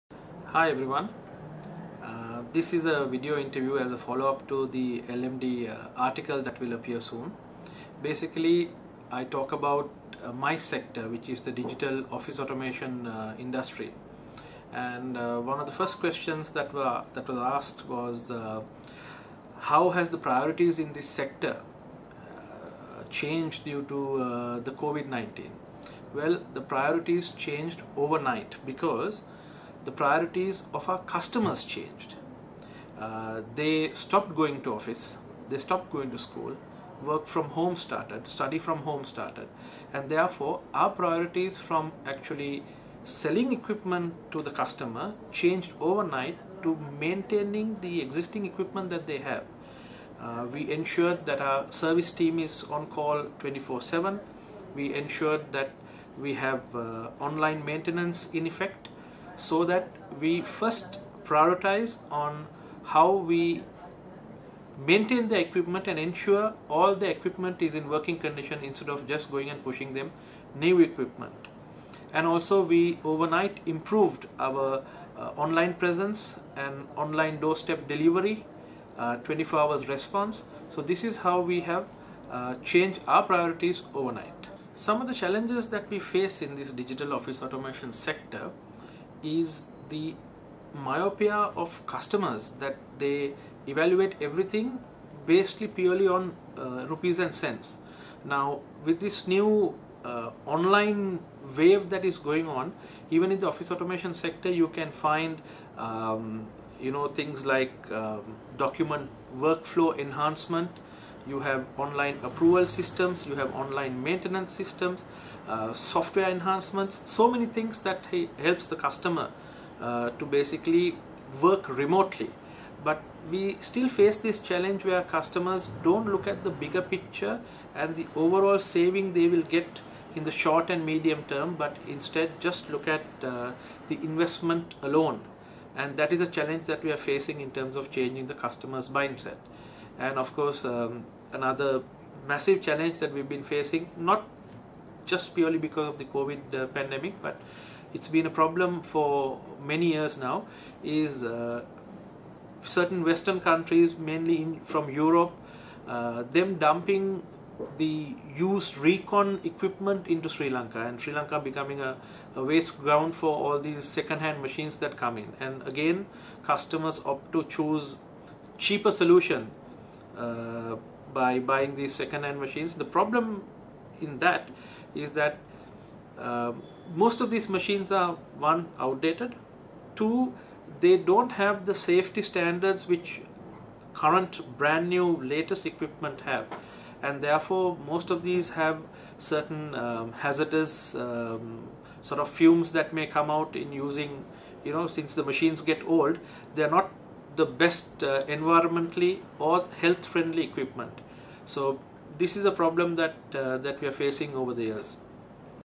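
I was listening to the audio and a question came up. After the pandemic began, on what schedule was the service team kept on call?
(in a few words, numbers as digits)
24/7.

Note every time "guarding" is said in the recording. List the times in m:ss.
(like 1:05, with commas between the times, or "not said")
not said.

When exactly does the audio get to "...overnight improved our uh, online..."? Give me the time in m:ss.
1:13.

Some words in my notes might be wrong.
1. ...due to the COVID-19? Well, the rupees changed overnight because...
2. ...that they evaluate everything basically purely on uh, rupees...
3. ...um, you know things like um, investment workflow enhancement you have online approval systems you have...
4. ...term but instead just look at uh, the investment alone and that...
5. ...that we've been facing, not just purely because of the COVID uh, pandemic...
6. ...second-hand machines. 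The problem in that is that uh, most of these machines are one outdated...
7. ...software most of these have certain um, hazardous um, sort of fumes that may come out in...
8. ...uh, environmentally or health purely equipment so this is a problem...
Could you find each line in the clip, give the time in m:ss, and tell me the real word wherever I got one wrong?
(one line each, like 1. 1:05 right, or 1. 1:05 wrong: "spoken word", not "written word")
1. 0:23 wrong: "priorities", not "rupees"
2. 1:32 right
3. 1:45 wrong: "document", not "investment"
4. 2:11 right
5. 2:22 right
6. 2:51 right
7. 3:07 wrong: "therefore", not "software"
8. 3:18 wrong: "friendly", not "purely".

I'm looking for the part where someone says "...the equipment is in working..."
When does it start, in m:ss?
1:06.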